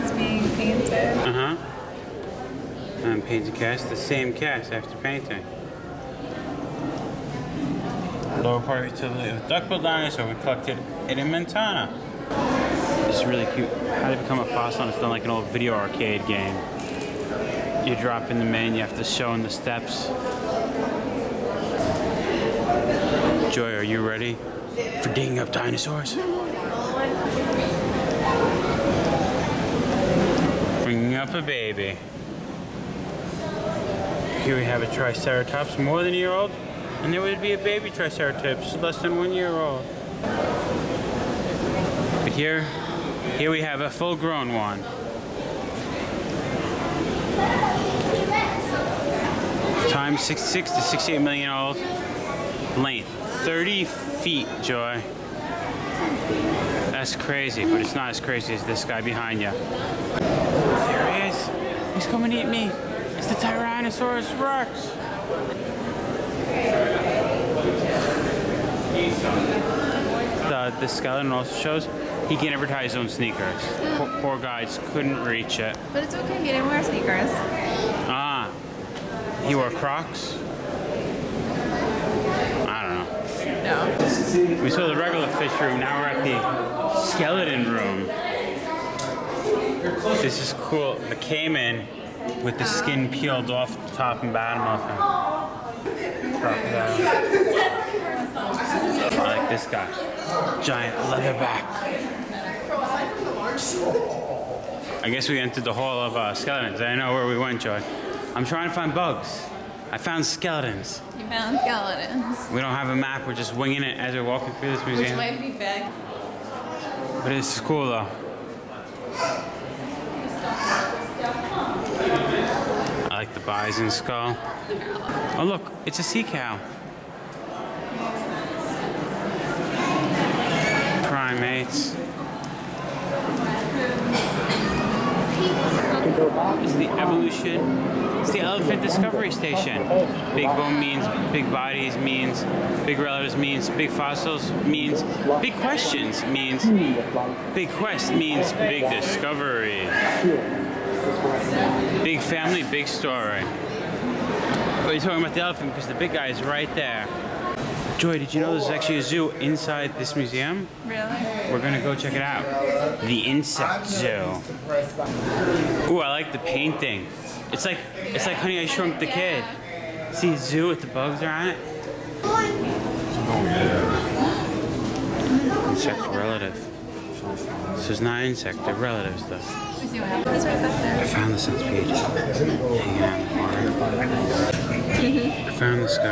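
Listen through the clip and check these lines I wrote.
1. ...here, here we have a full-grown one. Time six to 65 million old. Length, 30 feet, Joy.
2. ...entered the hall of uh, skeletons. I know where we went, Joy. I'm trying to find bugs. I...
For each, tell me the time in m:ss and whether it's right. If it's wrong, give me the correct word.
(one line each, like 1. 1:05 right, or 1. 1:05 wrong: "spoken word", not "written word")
1. 0:42 wrong: "68", not "65"
2. 1:45 right.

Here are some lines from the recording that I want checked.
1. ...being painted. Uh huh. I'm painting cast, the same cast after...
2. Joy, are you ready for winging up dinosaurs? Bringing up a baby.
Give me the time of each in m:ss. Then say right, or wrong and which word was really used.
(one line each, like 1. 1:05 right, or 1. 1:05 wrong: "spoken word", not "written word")
1. 0:00 right
2. 0:23 wrong: "digging", not "winging".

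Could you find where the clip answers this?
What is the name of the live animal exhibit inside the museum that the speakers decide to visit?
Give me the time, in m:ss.
2:43.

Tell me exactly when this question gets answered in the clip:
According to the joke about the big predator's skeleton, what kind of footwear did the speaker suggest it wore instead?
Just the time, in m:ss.
1:19.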